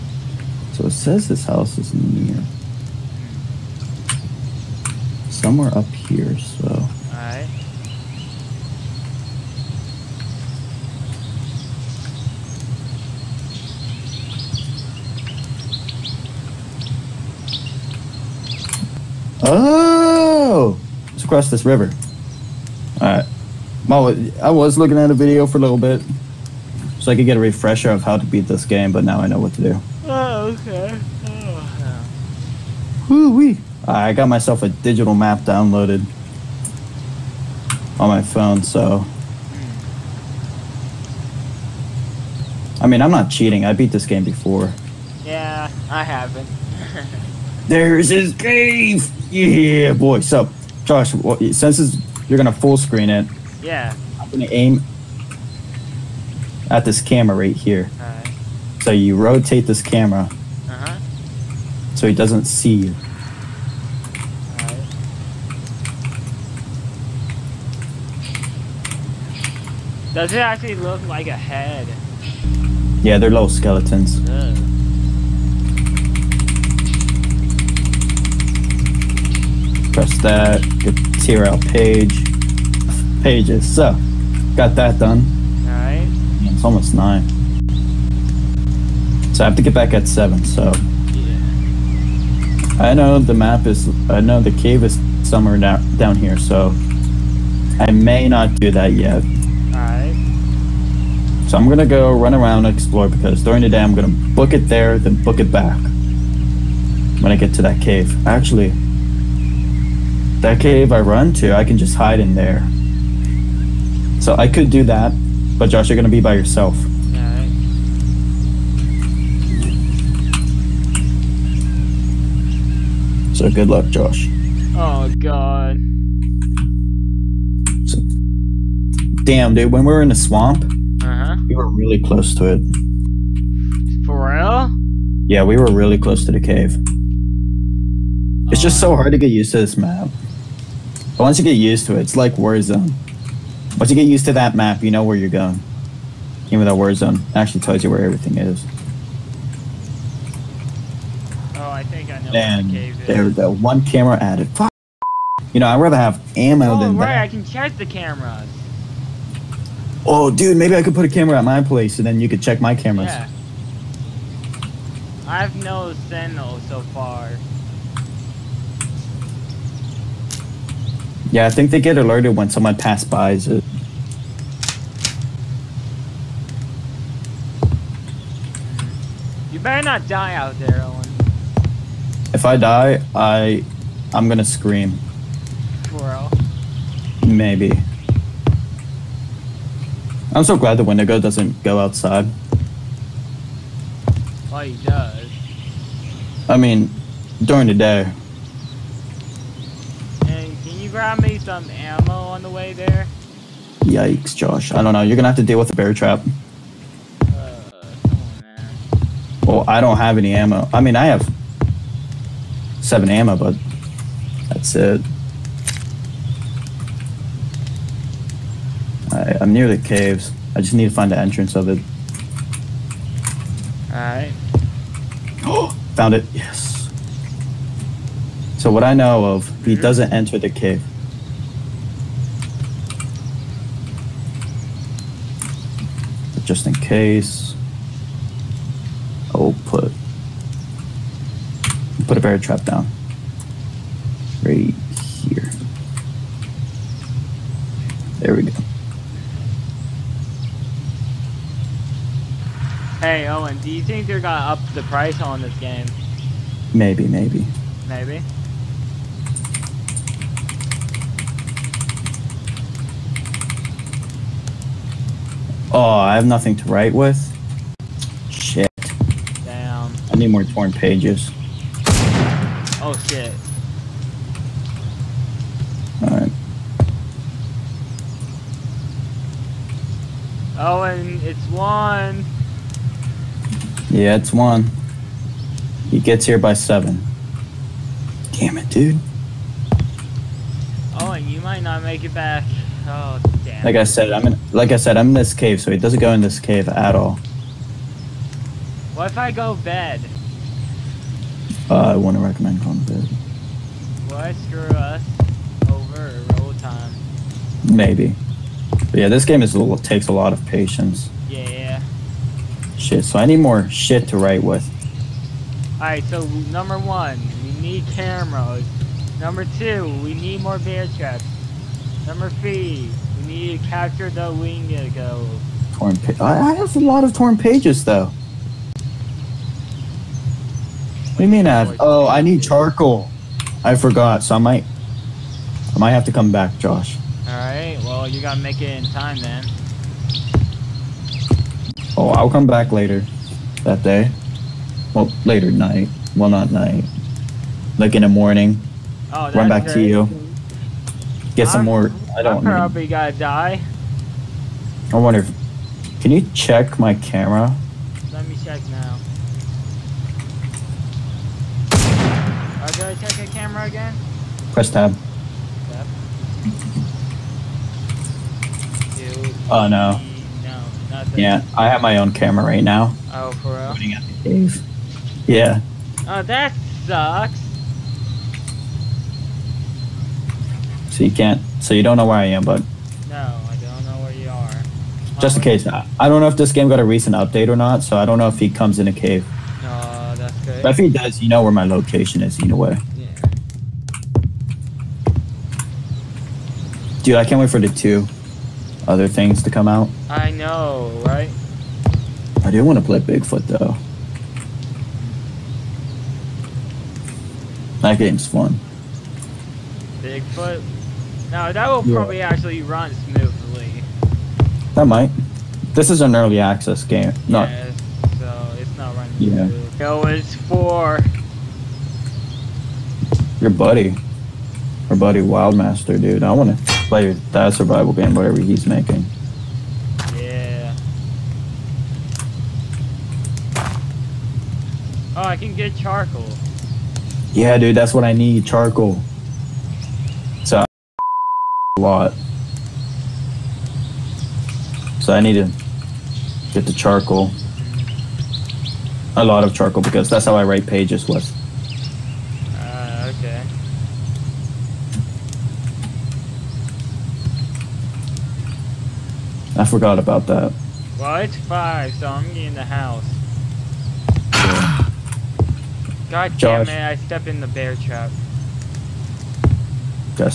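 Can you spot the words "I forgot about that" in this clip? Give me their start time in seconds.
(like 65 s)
459 s.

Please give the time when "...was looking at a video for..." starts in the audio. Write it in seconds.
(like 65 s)
24 s.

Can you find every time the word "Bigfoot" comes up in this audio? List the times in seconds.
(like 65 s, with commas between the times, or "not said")
402 s, 409 s.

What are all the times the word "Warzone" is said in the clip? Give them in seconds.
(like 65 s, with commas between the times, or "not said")
142 s, 146 s.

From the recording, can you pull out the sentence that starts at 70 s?
Does it actually look like a head?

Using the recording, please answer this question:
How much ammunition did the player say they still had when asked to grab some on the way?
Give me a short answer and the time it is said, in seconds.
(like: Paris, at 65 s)
7, at 212 s.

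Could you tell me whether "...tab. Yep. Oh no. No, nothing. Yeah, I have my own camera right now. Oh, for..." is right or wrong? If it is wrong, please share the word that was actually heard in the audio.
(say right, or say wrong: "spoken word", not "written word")
right.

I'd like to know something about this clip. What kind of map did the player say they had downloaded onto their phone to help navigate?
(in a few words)
digital map.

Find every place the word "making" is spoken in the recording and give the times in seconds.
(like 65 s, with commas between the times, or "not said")
428 s.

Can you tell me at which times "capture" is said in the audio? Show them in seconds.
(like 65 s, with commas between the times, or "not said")
323 s.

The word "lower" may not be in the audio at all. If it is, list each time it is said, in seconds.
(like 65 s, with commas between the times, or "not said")
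not said.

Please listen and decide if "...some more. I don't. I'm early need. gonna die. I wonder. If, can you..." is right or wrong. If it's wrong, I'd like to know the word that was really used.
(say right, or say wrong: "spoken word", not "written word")
wrong: "probably", not "early".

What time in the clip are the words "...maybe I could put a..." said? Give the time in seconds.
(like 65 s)
160 s.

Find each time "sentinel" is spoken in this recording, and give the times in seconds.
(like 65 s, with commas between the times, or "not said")
166 s.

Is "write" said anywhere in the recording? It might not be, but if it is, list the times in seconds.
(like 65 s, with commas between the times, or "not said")
266 s, 314 s, 450 s.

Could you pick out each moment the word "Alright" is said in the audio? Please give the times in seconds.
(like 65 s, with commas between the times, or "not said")
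7 s, 57 s, 117 s, 223 s, 276 s, 337 s.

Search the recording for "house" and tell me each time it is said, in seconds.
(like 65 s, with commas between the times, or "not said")
1 s, 462 s.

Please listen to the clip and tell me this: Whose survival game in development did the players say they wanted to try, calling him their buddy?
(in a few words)
Wildmaster.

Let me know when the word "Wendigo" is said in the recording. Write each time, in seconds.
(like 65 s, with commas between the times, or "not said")
190 s, 324 s.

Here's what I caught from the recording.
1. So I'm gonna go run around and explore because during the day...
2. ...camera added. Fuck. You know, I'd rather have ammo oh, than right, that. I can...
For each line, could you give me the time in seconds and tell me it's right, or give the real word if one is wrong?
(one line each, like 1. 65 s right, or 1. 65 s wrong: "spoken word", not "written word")
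1. 101 s right
2. 153 s right.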